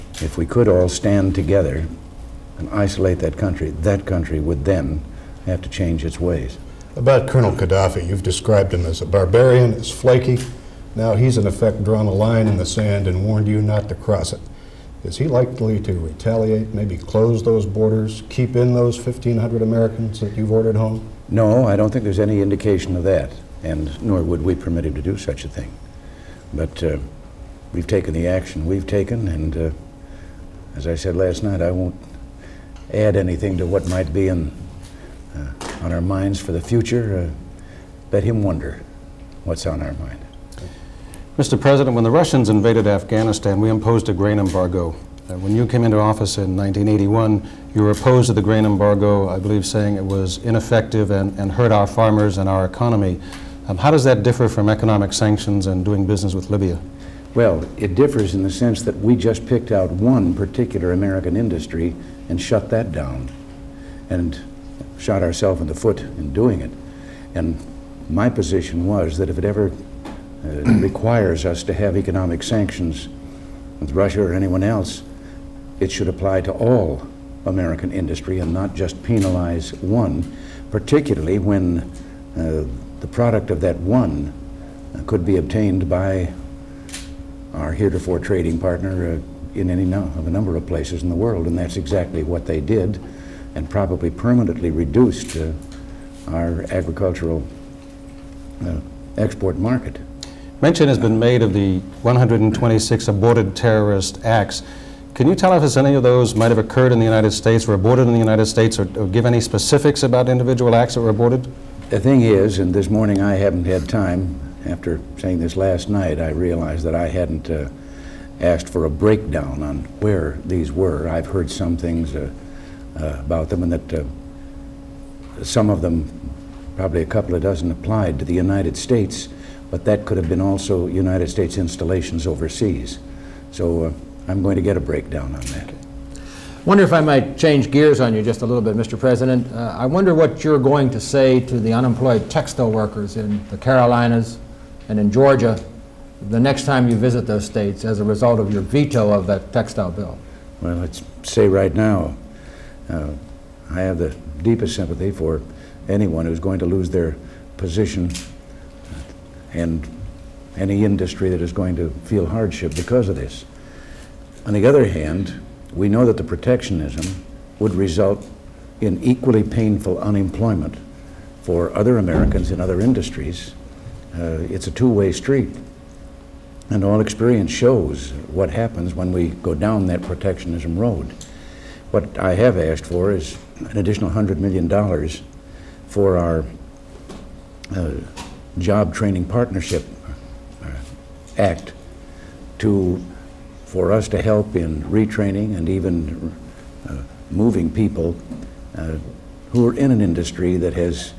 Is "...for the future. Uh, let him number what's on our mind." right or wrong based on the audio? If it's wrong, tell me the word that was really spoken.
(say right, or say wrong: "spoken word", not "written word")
wrong: "wonder", not "number".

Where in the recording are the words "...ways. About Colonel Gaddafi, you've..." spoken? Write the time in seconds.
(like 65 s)
6 s.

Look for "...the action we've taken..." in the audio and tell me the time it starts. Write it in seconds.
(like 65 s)
28 s.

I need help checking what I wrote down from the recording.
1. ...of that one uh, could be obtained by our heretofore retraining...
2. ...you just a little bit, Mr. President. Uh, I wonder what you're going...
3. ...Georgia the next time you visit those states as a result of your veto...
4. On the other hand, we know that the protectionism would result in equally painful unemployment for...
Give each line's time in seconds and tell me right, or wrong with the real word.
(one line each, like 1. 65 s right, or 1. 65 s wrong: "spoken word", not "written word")
1. 83 s wrong: "trading", not "retraining"
2. 138 s right
3. 145 s right
4. 164 s right.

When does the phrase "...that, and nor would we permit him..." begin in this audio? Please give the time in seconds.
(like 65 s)
23 s.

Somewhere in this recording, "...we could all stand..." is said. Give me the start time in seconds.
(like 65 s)
0 s.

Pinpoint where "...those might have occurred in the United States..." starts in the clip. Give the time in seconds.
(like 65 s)
106 s.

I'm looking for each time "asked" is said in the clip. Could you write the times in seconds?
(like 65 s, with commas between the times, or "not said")
118 s, 182 s.